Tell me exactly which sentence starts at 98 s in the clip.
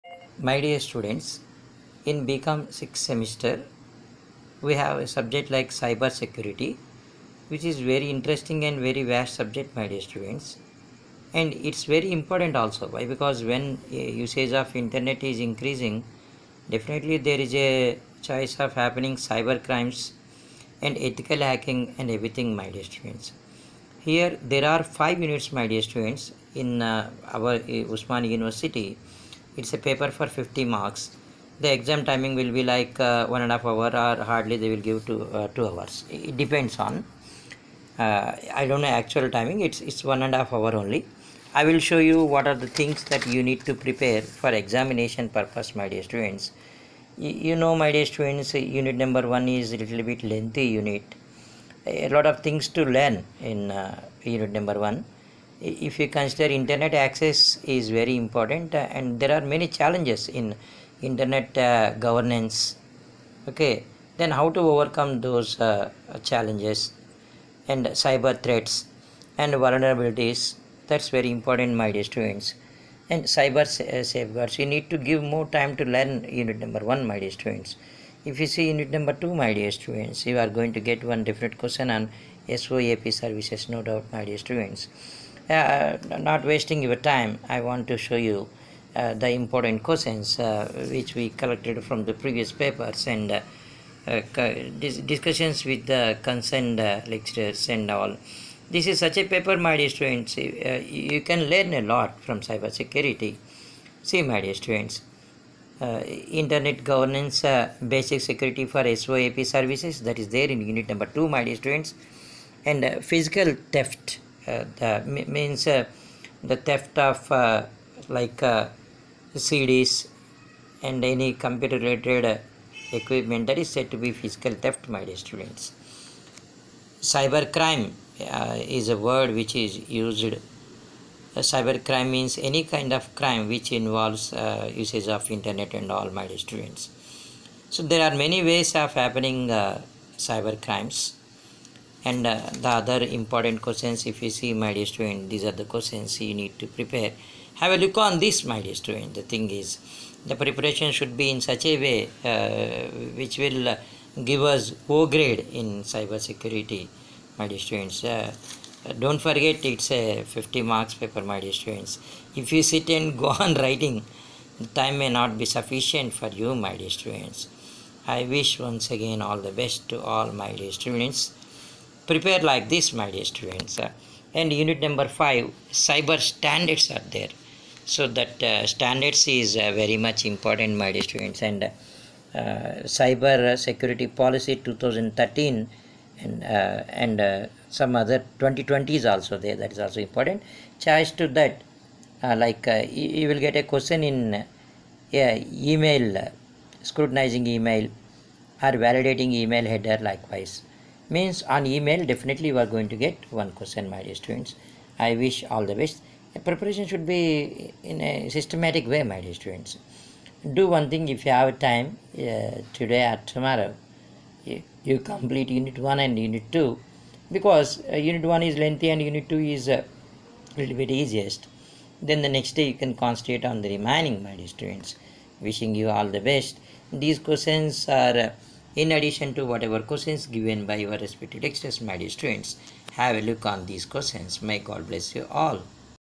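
This is such a paper, my dear students.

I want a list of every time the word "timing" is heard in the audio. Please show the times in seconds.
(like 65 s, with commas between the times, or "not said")
32 s, 39 s.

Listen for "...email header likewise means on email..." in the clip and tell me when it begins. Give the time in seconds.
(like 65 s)
199 s.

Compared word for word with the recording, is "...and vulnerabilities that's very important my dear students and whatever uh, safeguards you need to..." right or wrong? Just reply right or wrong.
wrong.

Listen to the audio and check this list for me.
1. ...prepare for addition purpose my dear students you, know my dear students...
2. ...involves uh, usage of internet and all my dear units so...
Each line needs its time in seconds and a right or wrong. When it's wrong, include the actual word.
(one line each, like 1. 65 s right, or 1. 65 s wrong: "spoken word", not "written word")
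1. 43 s wrong: "examination", not "addition"
2. 133 s wrong: "students", not "units".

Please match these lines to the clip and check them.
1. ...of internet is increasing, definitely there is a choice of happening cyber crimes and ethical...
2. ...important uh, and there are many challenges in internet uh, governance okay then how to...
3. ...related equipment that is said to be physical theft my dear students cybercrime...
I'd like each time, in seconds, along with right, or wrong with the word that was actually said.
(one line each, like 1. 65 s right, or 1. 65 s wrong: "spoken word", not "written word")
1. 14 s right
2. 58 s right
3. 121 s right.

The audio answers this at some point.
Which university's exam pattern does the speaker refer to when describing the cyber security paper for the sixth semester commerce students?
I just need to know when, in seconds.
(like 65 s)
27 s.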